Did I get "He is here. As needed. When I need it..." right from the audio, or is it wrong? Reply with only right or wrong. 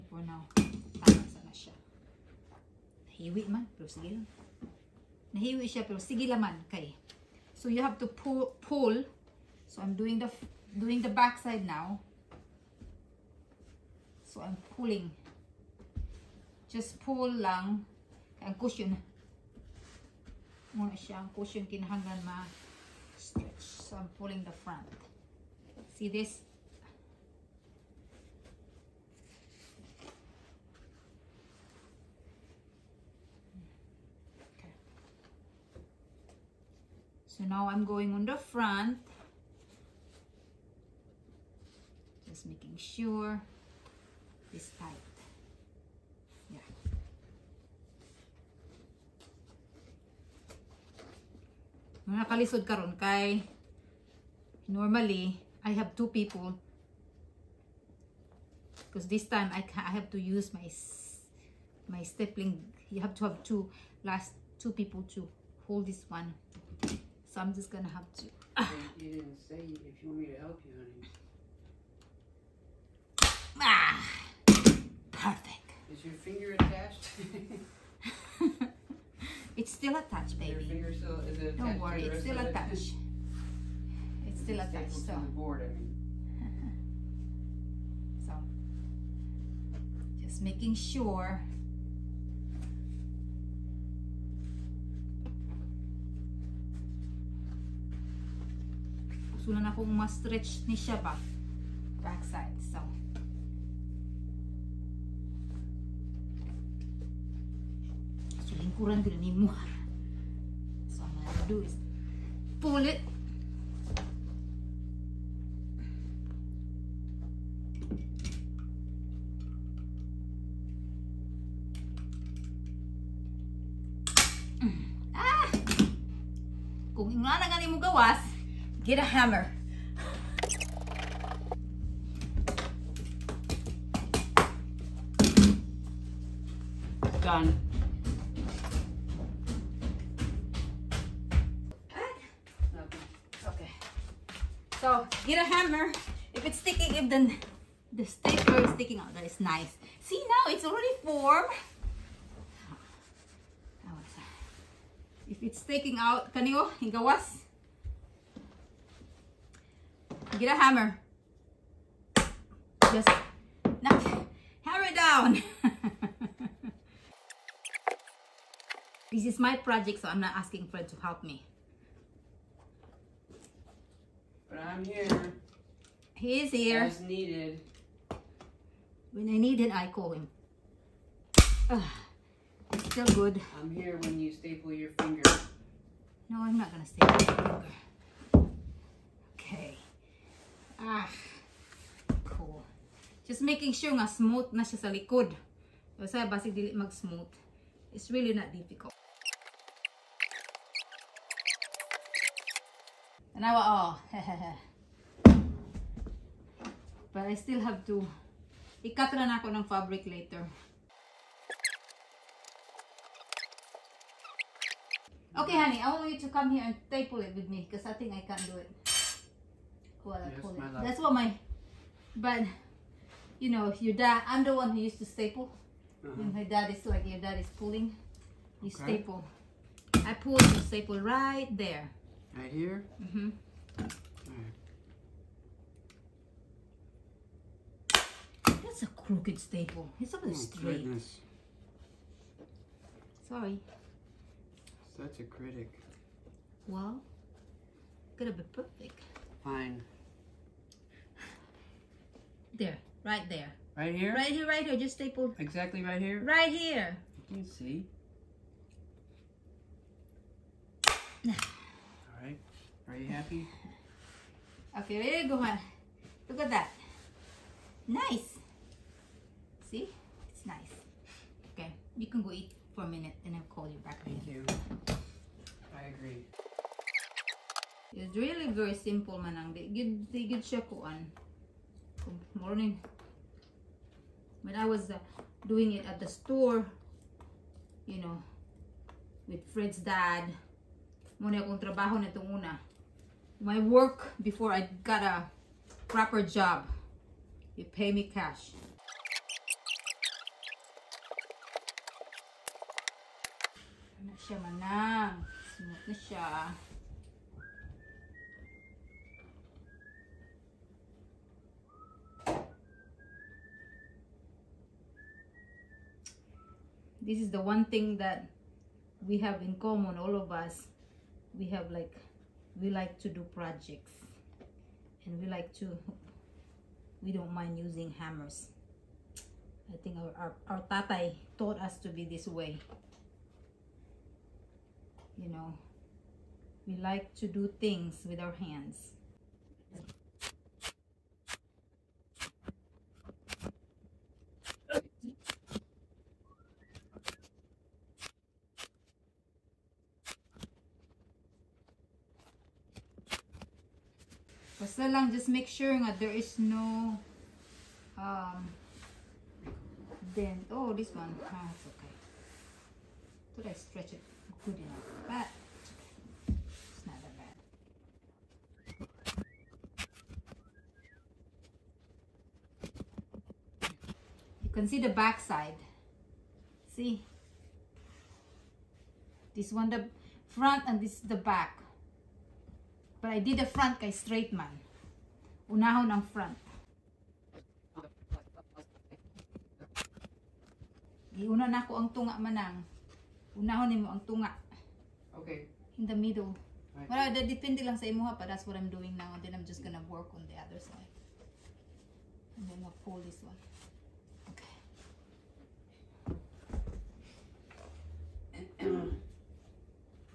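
right.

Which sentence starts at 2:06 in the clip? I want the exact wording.
kung nga na gani mo gawas Get a hammer.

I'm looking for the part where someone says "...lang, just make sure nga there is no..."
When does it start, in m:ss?
5:54.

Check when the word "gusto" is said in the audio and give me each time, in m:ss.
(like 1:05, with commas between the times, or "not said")
1:39.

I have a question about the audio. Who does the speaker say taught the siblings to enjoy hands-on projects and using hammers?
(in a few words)
Tatai.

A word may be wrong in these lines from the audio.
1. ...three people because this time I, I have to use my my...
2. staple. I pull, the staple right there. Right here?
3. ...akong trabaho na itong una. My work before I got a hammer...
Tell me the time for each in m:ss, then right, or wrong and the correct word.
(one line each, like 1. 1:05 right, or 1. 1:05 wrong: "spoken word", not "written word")
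1. 0:55 wrong: "two", not "three"
2. 3:49 right
3. 4:51 wrong: "proper", not "hammer".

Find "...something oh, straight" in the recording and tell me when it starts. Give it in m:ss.
4:00.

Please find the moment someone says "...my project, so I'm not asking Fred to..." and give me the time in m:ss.
2:49.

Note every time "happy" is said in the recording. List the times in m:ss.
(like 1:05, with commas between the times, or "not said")
4:23.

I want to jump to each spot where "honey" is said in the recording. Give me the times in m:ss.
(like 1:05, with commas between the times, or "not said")
1:10, 3:35.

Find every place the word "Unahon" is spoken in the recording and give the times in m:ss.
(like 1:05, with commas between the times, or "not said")
6:25, 6:33.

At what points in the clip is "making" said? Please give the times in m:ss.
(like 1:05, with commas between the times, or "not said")
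0:42, 1:30, 3:13.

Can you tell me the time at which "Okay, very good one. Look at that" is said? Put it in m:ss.
4:24.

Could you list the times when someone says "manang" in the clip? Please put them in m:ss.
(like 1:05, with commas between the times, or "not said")
4:39, 5:04, 6:32.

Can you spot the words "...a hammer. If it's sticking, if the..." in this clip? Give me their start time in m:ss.
2:25.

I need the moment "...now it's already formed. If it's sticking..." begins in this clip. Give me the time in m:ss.
2:30.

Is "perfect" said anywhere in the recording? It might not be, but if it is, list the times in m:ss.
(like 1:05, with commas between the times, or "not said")
1:15, 4:08.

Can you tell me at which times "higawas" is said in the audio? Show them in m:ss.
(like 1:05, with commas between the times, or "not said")
2:36.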